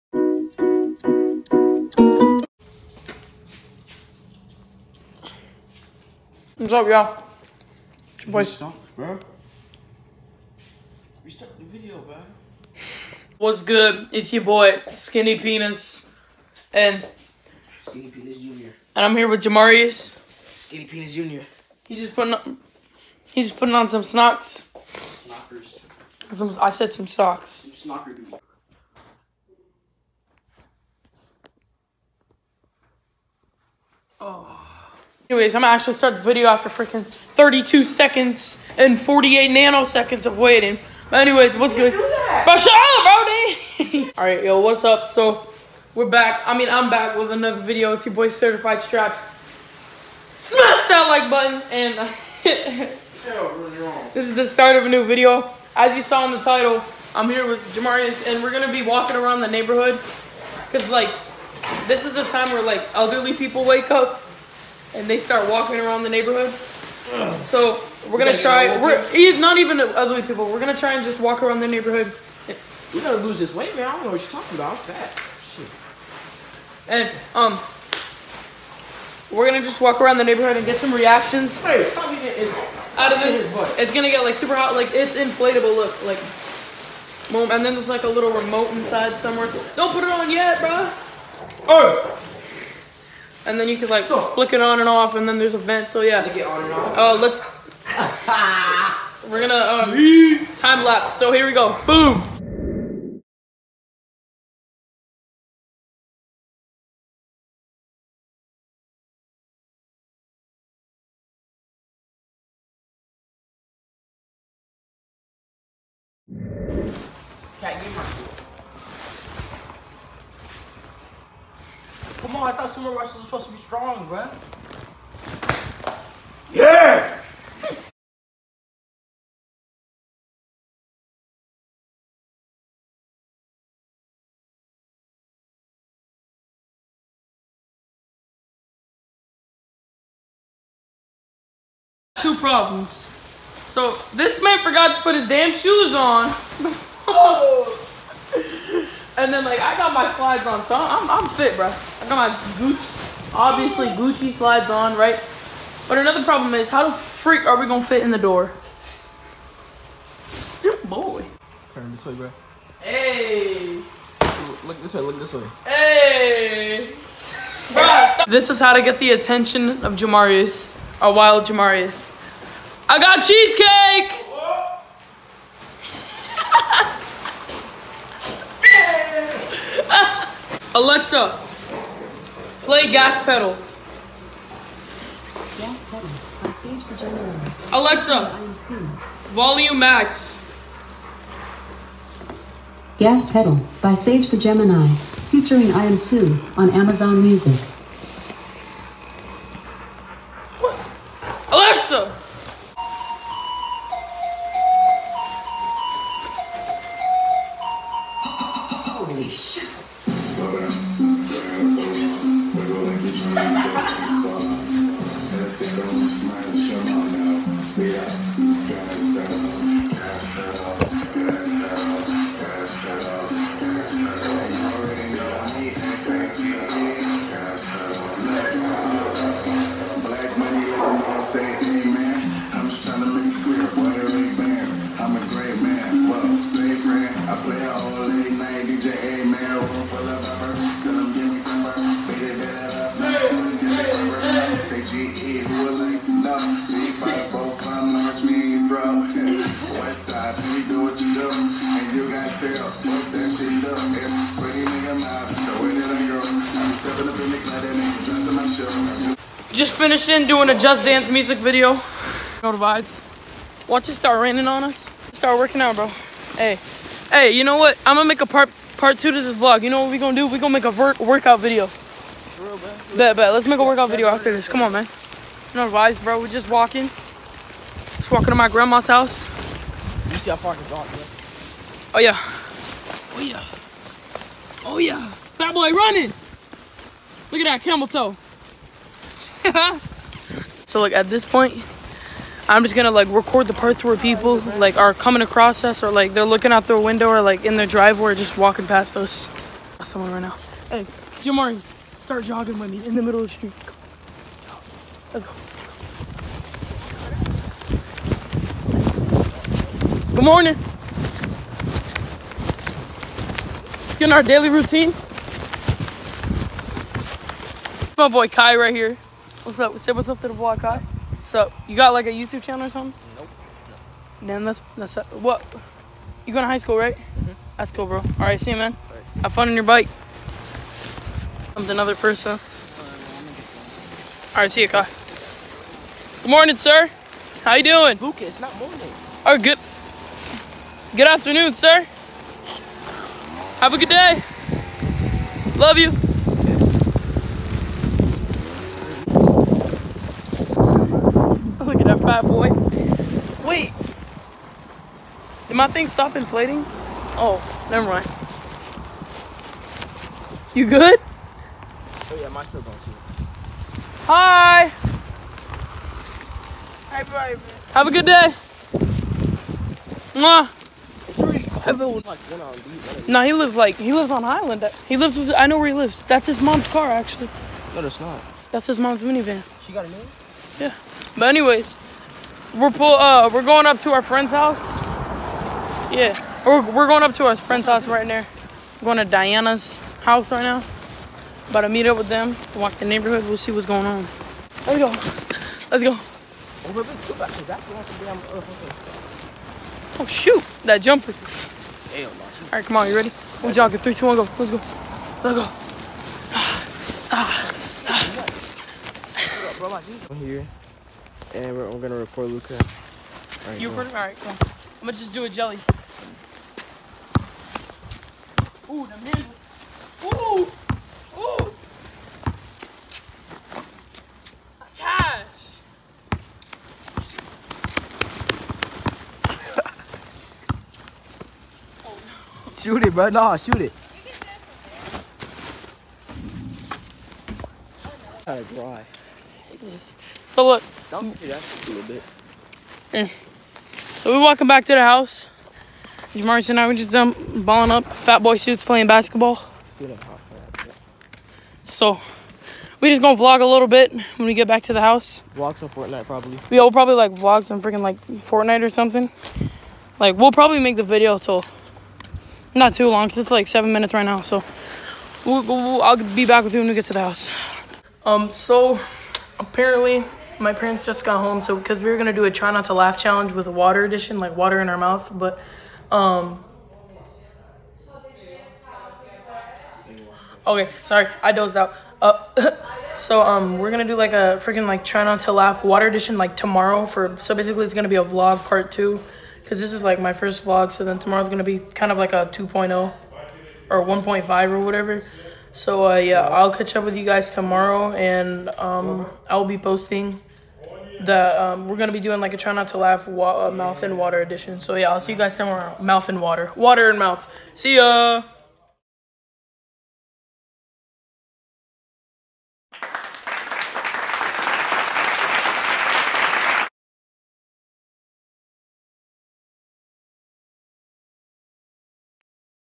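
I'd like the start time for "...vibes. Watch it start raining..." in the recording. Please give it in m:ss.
4:22.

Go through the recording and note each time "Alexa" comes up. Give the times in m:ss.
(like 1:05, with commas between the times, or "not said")
3:00, 3:07.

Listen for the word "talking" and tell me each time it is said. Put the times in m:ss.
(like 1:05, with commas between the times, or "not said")
1:14.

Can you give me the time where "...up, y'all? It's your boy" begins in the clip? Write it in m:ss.
0:06.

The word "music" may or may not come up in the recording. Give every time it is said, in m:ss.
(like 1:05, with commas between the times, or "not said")
3:17, 4:21.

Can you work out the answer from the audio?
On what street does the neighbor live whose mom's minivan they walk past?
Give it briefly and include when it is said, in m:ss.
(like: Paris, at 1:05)
Highland, at 6:14.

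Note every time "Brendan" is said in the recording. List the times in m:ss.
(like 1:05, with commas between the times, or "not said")
not said.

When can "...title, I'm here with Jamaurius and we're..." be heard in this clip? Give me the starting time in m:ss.
0:56.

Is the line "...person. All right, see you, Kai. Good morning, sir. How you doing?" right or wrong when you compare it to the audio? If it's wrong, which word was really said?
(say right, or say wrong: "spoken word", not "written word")
right.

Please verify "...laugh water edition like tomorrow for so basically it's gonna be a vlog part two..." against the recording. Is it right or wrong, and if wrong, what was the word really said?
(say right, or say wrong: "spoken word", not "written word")
right.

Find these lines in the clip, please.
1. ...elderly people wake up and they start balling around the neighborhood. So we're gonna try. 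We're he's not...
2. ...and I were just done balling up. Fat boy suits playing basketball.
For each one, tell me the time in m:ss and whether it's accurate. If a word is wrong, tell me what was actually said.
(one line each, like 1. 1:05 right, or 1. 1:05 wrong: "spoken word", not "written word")
1. 1:02 wrong: "walking", not "balling"
2. 7:26 right.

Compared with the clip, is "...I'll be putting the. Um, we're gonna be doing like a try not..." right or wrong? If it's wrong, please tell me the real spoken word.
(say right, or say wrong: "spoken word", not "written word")
wrong: "posting", not "putting".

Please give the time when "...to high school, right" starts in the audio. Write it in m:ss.
5:26.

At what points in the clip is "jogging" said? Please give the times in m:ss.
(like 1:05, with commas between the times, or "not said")
5:02, 6:43.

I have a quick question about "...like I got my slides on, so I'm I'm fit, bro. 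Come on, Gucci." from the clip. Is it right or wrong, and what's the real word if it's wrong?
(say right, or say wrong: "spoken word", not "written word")
right.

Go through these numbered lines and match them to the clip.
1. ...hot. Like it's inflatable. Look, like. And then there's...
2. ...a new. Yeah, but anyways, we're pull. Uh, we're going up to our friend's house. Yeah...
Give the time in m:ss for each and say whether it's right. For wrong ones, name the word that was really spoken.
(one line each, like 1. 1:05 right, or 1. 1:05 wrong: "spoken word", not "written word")
1. 1:24 right
2. 6:19 right.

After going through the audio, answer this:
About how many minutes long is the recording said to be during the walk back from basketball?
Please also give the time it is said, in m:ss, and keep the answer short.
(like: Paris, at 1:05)
7, at 7:43.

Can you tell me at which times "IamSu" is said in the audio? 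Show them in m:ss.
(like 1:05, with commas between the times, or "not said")
3:15.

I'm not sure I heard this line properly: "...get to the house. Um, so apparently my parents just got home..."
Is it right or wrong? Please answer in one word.
right.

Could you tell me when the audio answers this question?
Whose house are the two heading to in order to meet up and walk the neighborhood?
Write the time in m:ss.
6:29.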